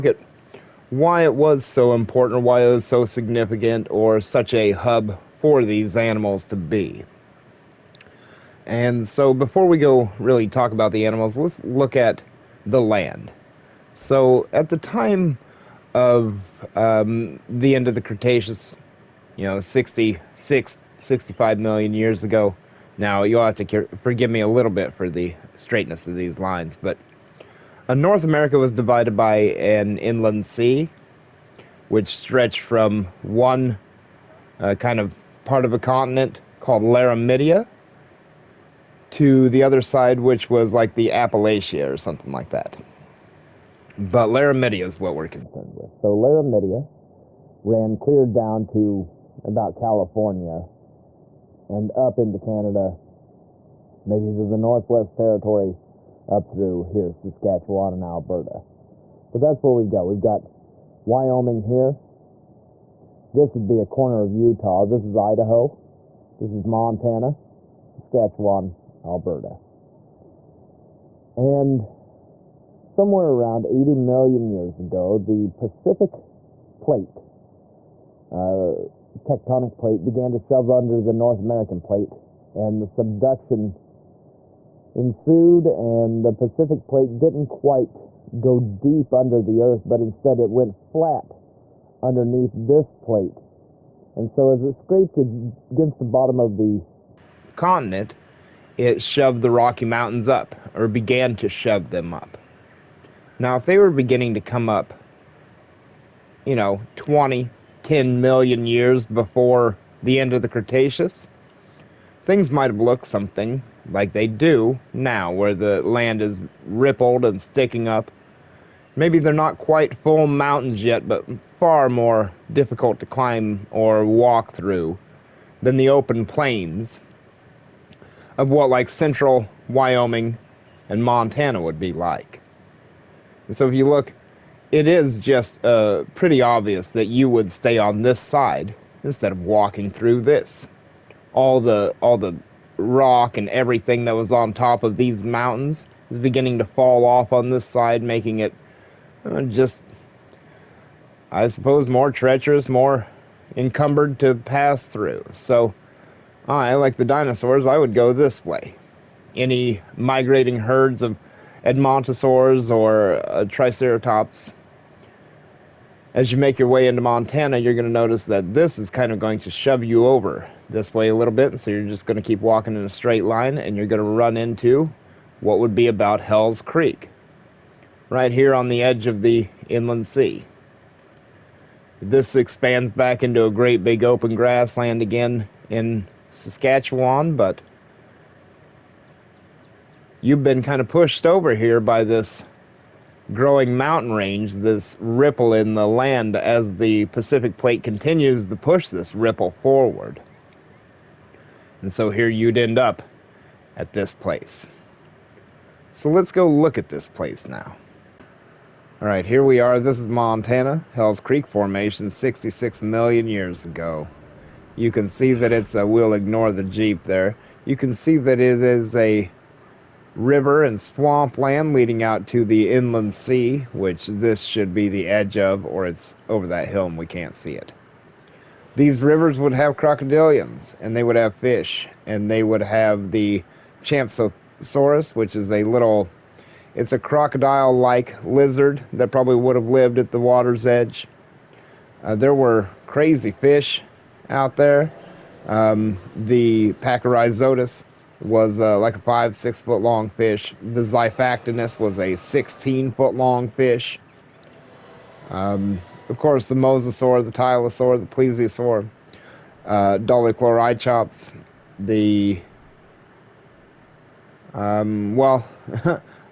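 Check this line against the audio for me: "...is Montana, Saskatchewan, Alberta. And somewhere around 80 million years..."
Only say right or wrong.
right.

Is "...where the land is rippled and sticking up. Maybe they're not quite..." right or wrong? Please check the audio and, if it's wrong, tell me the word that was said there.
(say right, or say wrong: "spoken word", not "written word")
right.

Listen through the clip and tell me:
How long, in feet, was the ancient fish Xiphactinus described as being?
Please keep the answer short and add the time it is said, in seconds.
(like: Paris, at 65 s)
16 feet, at 252 s.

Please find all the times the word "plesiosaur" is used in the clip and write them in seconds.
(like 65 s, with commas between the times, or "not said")
258 s.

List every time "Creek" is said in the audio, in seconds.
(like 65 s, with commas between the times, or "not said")
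176 s, 211 s.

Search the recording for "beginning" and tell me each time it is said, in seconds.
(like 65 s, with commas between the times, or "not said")
103 s, 146 s.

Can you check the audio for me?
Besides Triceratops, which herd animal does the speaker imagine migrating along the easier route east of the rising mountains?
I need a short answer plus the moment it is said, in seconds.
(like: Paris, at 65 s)
Edmontosaurs, at 161 s.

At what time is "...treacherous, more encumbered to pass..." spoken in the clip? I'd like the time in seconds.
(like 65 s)
152 s.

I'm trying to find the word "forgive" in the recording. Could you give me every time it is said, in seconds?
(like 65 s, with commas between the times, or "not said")
24 s.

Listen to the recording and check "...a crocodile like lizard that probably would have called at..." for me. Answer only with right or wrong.
wrong.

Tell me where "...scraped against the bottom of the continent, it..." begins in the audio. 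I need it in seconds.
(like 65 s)
94 s.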